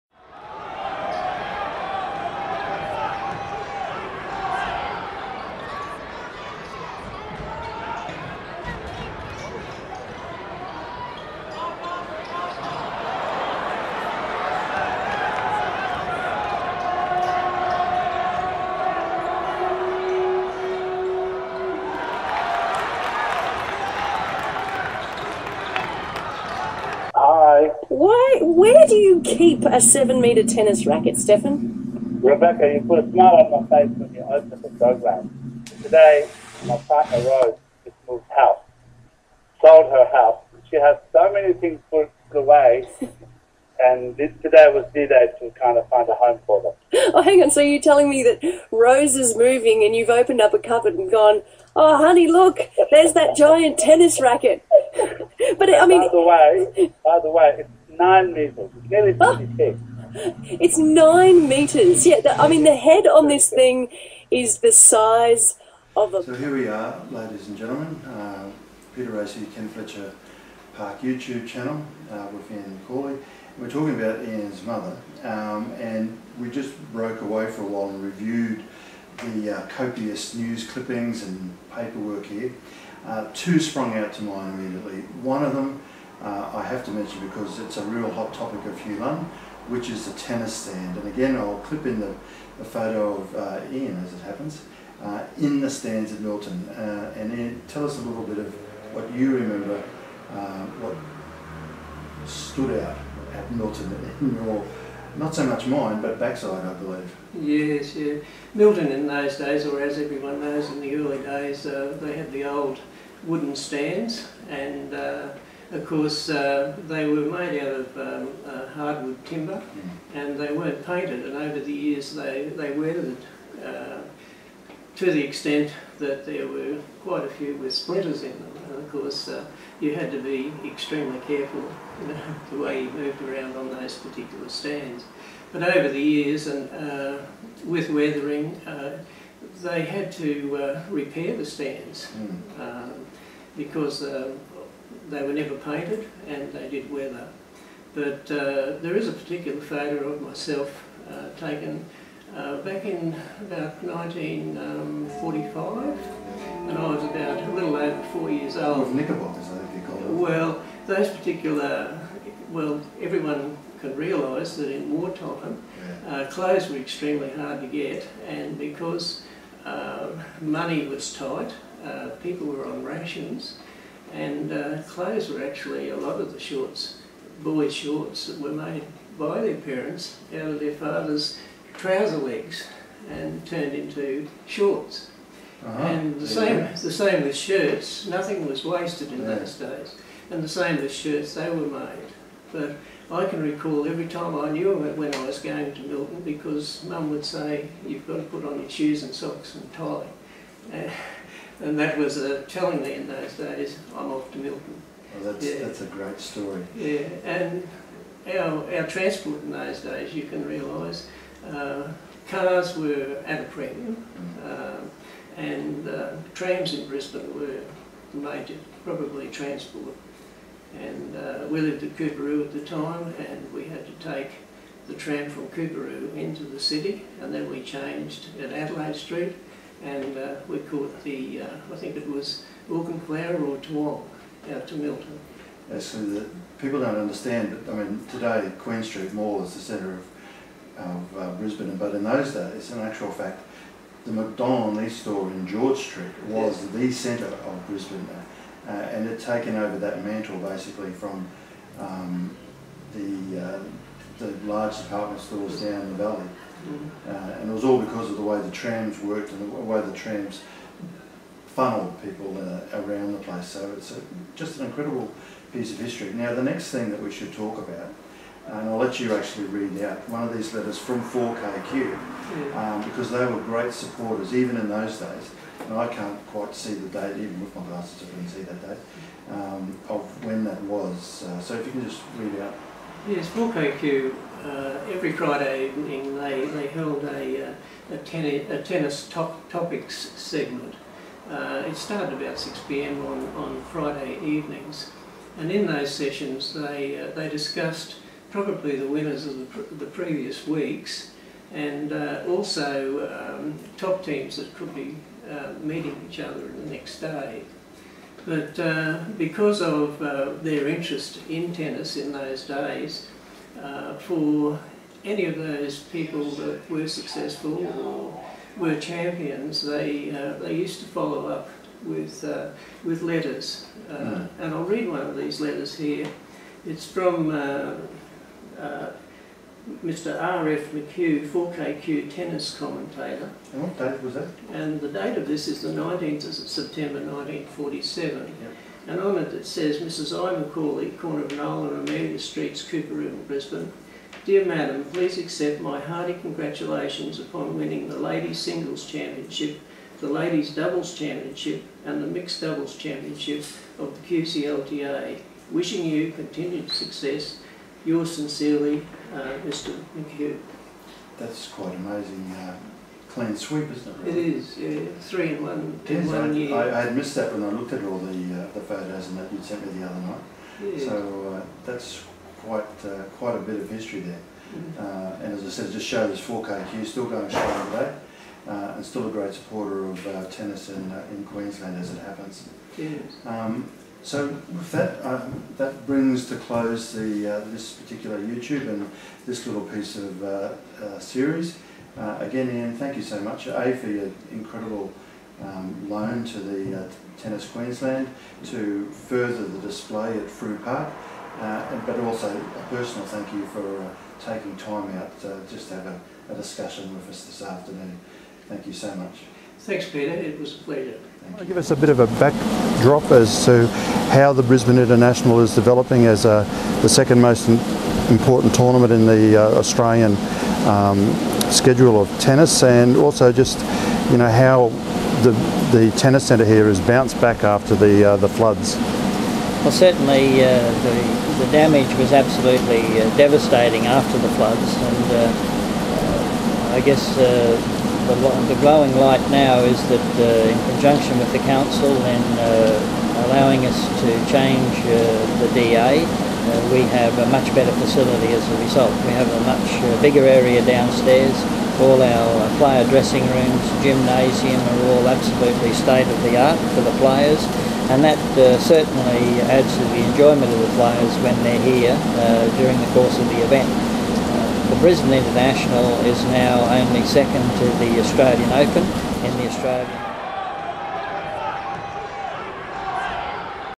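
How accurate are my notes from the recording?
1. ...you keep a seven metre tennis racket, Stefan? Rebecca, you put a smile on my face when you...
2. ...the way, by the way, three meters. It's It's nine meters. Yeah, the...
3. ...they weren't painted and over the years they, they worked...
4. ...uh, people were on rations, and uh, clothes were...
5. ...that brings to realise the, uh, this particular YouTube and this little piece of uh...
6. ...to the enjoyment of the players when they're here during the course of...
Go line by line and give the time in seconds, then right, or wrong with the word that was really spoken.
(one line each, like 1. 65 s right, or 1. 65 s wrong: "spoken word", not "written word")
1. 28 s right
2. 56 s wrong: "nine", not "three"
3. 120 s wrong: "weathered", not "worked"
4. 171 s right
5. 385 s wrong: "close", not "realise"
6. 459 s right.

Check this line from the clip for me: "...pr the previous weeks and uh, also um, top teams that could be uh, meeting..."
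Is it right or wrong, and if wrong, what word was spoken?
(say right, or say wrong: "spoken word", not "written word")
right.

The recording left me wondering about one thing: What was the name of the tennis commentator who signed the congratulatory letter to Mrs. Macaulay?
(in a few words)
R.F. McHugh.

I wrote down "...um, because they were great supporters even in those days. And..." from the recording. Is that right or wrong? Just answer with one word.
right.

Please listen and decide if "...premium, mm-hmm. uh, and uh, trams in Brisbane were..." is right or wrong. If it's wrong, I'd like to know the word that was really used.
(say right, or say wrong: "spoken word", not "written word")
right.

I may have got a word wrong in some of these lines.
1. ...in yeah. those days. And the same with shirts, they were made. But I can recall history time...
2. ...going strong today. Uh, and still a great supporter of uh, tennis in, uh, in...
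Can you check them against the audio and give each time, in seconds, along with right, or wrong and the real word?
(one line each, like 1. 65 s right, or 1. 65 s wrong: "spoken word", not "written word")
1. 189 s wrong: "every", not "history"
2. 377 s right.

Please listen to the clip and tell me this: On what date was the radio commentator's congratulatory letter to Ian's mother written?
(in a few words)
19 September 1947.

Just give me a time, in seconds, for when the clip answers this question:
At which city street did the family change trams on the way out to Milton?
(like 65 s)
228 s.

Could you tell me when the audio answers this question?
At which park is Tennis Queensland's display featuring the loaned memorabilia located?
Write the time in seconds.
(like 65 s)
400 s.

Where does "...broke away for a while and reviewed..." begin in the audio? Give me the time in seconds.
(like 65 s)
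76 s.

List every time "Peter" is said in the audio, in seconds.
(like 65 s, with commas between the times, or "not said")
68 s, 409 s.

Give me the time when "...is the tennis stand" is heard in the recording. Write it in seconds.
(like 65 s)
89 s.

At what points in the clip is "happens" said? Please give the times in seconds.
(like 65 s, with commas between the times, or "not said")
94 s, 381 s.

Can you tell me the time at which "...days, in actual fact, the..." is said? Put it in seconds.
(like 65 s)
242 s.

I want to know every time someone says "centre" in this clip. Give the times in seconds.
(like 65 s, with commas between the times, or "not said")
239 s, 246 s, 426 s.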